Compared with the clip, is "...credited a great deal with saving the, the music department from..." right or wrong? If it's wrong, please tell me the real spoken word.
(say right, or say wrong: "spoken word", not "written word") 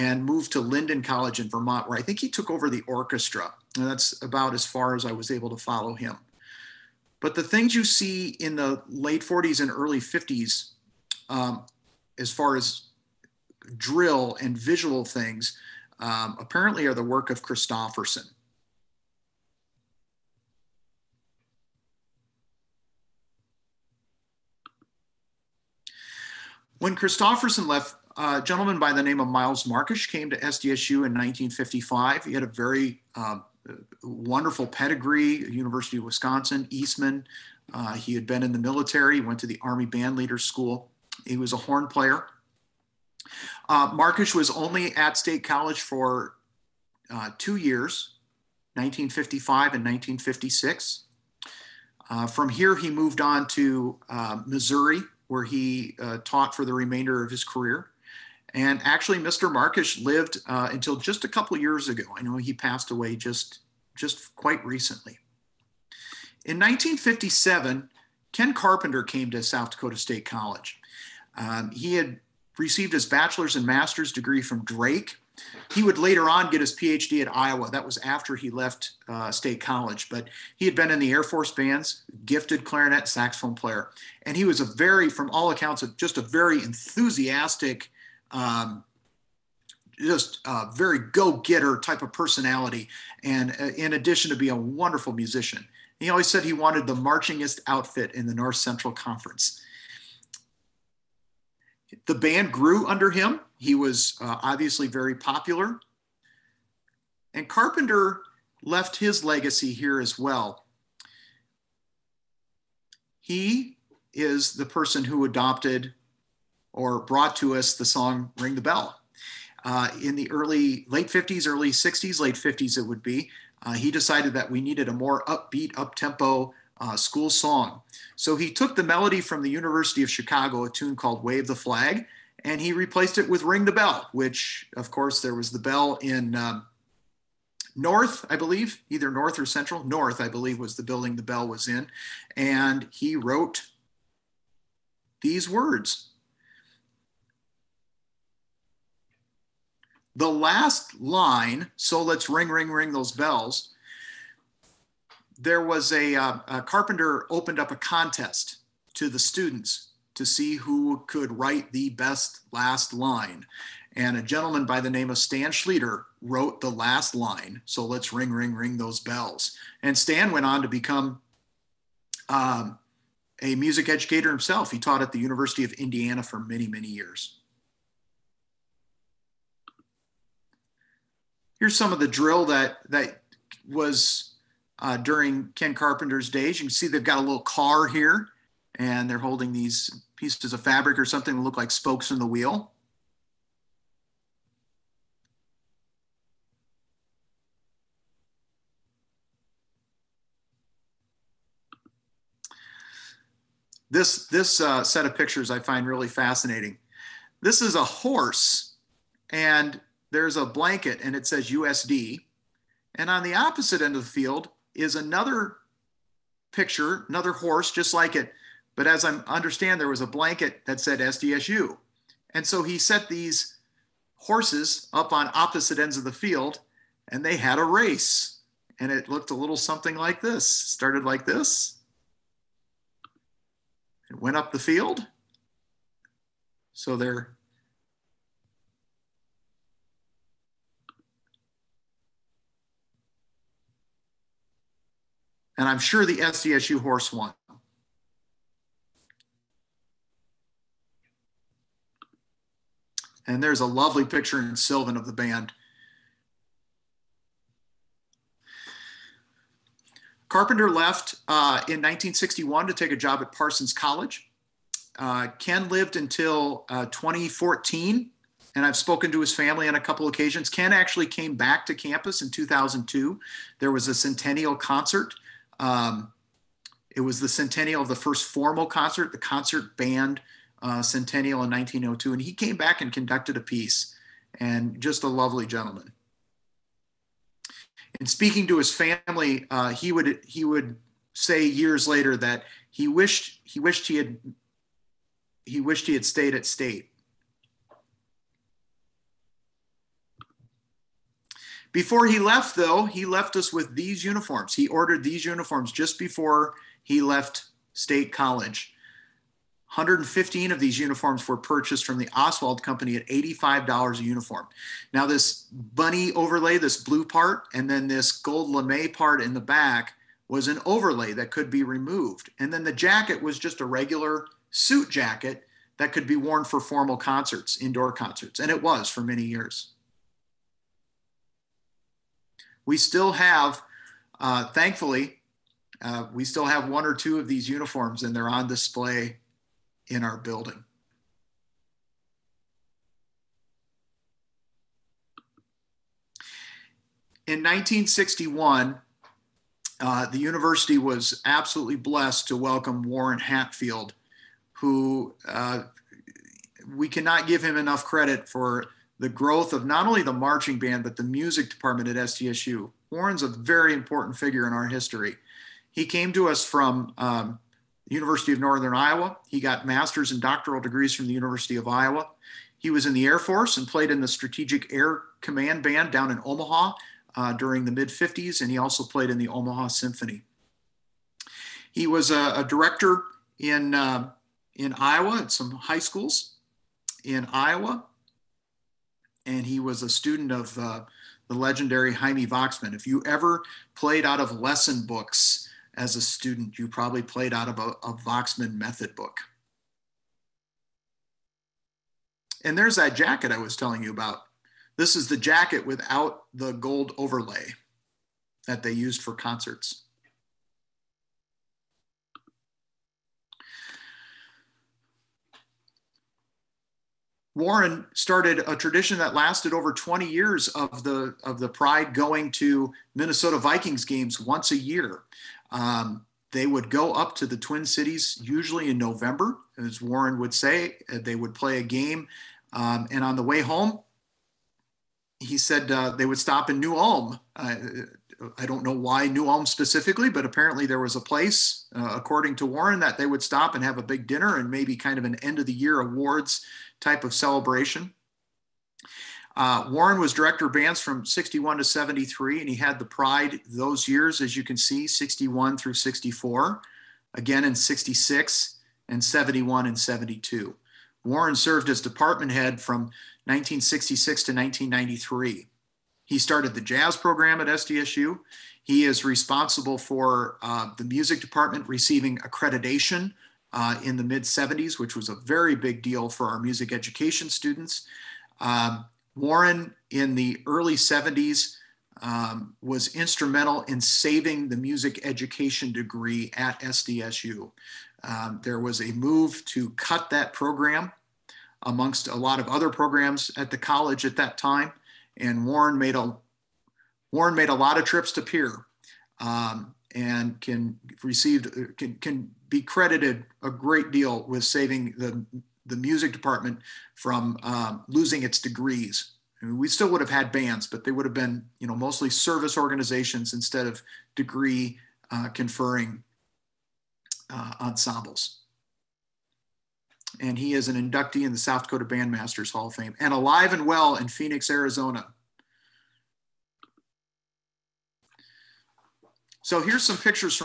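right.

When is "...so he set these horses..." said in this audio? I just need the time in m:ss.
3:42.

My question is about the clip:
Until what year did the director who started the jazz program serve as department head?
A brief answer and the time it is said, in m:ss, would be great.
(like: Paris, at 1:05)
1993, at 7:44.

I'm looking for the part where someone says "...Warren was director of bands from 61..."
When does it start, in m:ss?
7:29.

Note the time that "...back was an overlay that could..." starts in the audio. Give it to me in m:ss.
5:19.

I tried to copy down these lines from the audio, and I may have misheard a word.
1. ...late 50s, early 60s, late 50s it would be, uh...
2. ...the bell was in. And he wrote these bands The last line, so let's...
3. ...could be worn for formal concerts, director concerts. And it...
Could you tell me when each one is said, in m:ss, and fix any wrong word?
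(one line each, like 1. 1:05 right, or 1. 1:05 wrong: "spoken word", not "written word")
1. 2:00 right
2. 2:21 wrong: "words", not "bands"
3. 5:25 wrong: "indoor", not "director".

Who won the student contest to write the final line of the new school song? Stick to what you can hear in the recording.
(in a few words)
Stan Schleter.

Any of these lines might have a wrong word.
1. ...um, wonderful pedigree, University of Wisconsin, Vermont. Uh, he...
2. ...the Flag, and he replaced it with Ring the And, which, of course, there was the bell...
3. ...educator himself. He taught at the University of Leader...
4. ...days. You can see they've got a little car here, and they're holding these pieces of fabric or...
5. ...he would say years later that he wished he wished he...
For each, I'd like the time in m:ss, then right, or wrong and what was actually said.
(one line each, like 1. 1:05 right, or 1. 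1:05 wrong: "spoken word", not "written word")
1. 0:33 wrong: "Eastman", not "Vermont"
2. 2:11 wrong: "Bell", not "And"
3. 2:53 wrong: "Indiana", not "Leader"
4. 3:06 right
5. 4:50 right.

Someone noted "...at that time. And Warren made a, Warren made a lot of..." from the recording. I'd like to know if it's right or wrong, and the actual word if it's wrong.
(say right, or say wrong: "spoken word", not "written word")
right.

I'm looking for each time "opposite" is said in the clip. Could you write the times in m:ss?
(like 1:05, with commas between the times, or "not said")
3:33, 3:45.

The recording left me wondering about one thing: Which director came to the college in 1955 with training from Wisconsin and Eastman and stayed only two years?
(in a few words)
Miles Markish.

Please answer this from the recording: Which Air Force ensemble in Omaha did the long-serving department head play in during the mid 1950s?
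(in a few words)
Strategic Air Command Band.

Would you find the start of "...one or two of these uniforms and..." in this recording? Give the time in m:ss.
5:36.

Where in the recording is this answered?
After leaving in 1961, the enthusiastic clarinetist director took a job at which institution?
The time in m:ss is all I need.
4:23.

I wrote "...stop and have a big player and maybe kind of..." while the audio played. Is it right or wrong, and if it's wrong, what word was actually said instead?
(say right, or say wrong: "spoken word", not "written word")
wrong: "dinner", not "player".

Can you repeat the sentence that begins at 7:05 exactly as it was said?
Um, they would go up to the Twin Cities usually in November, as Warren would say.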